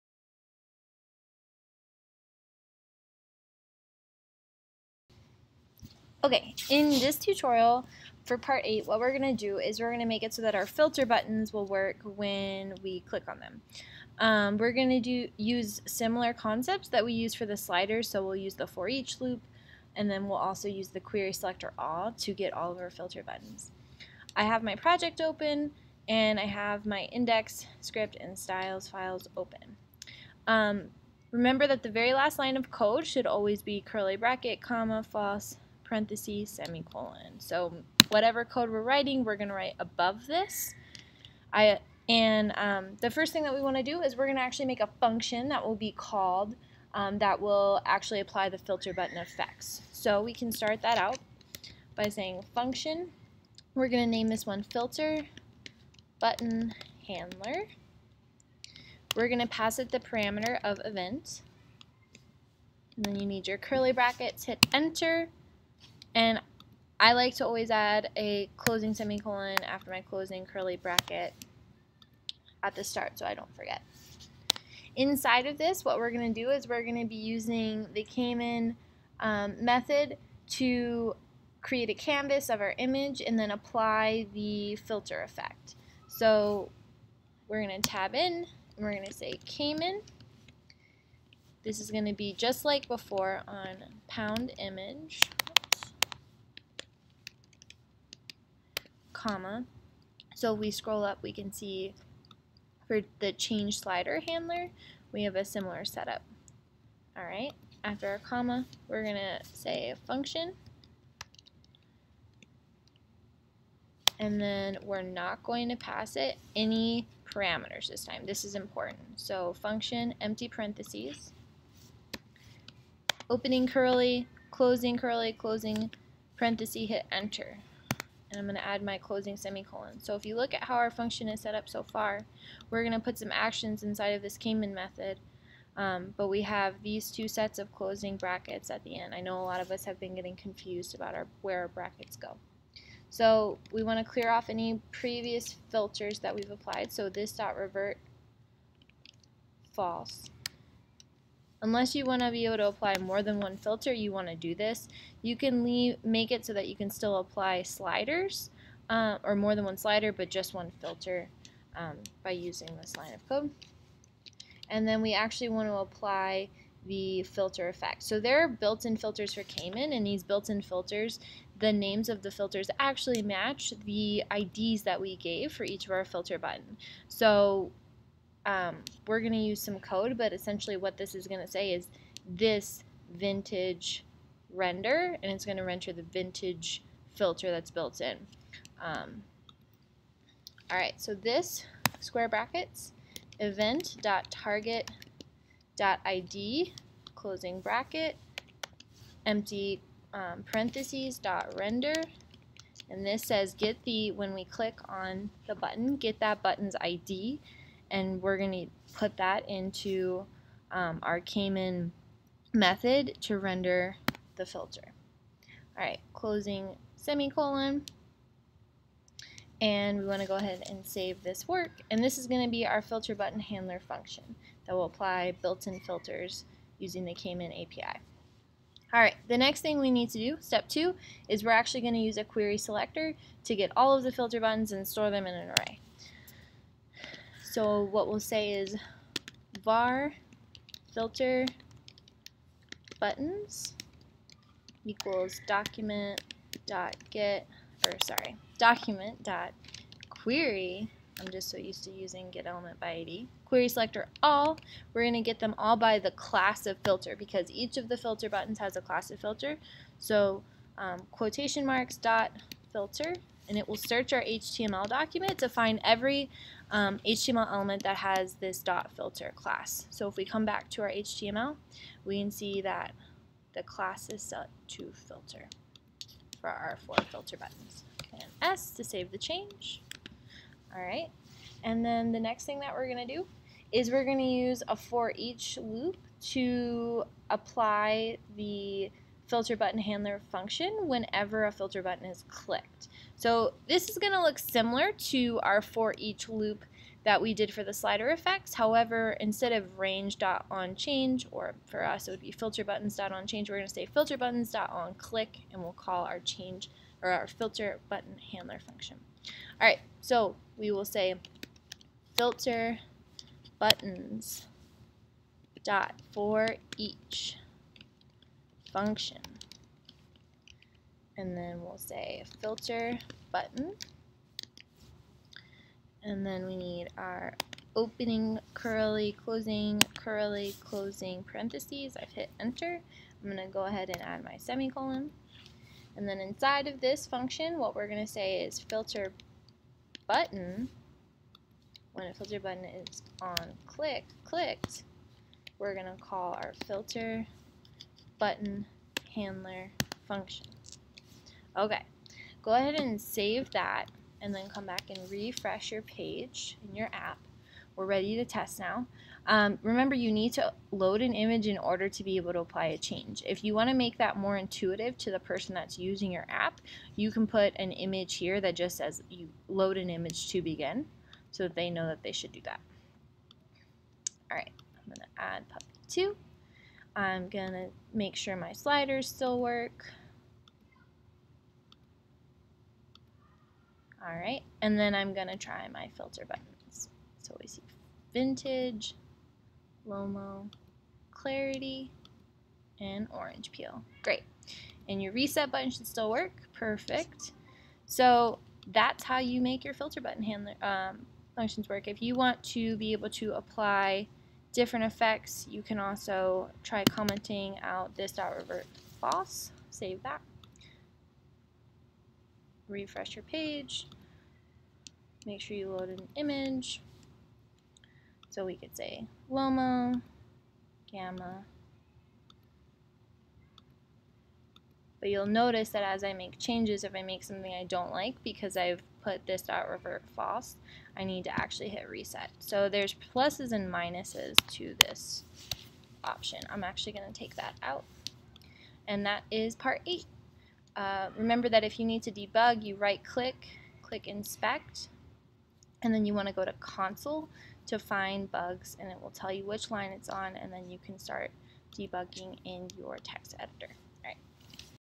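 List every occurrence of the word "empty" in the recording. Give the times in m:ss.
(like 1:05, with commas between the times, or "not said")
2:00, 3:19.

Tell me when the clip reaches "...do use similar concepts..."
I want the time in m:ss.
0:14.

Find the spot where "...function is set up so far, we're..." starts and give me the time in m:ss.
2:10.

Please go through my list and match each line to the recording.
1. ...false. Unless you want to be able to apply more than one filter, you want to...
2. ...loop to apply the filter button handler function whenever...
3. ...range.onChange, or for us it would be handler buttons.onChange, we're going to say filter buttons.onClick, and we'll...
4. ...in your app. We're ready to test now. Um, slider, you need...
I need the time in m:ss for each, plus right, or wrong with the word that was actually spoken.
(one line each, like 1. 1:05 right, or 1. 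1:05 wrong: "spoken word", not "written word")
1. 2:29 right
2. 4:45 right
3. 4:59 wrong: "filter", not "handler"
4. 5:56 wrong: "remember", not "slider".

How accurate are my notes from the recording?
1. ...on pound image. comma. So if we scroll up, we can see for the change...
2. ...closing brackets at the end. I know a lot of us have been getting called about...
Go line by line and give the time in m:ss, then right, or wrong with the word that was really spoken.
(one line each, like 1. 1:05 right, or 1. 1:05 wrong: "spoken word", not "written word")
1. 1:33 right
2. 2:17 wrong: "confused", not "called".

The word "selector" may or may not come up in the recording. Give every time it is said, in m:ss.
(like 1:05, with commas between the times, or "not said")
0:21, 3:52, 4:13.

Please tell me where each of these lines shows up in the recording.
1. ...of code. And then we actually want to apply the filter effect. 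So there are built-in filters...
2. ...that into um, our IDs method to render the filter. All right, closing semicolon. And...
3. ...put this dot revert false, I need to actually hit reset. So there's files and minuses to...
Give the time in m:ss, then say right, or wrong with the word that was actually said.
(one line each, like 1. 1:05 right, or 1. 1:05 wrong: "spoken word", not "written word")
1. 2:43 right
2. 3:29 wrong: "Caman", not "IDs"
3. 7:09 wrong: "pluses", not "files".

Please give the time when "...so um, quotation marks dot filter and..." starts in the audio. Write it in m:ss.
4:19.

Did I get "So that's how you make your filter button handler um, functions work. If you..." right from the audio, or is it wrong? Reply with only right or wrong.
right.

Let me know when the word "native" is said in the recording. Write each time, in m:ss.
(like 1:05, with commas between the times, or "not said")
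not said.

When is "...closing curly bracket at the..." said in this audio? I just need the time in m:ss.
1:10.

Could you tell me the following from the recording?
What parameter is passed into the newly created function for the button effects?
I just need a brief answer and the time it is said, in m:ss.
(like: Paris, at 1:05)
event, at 1:00.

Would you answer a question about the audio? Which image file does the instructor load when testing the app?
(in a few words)
puppy 2.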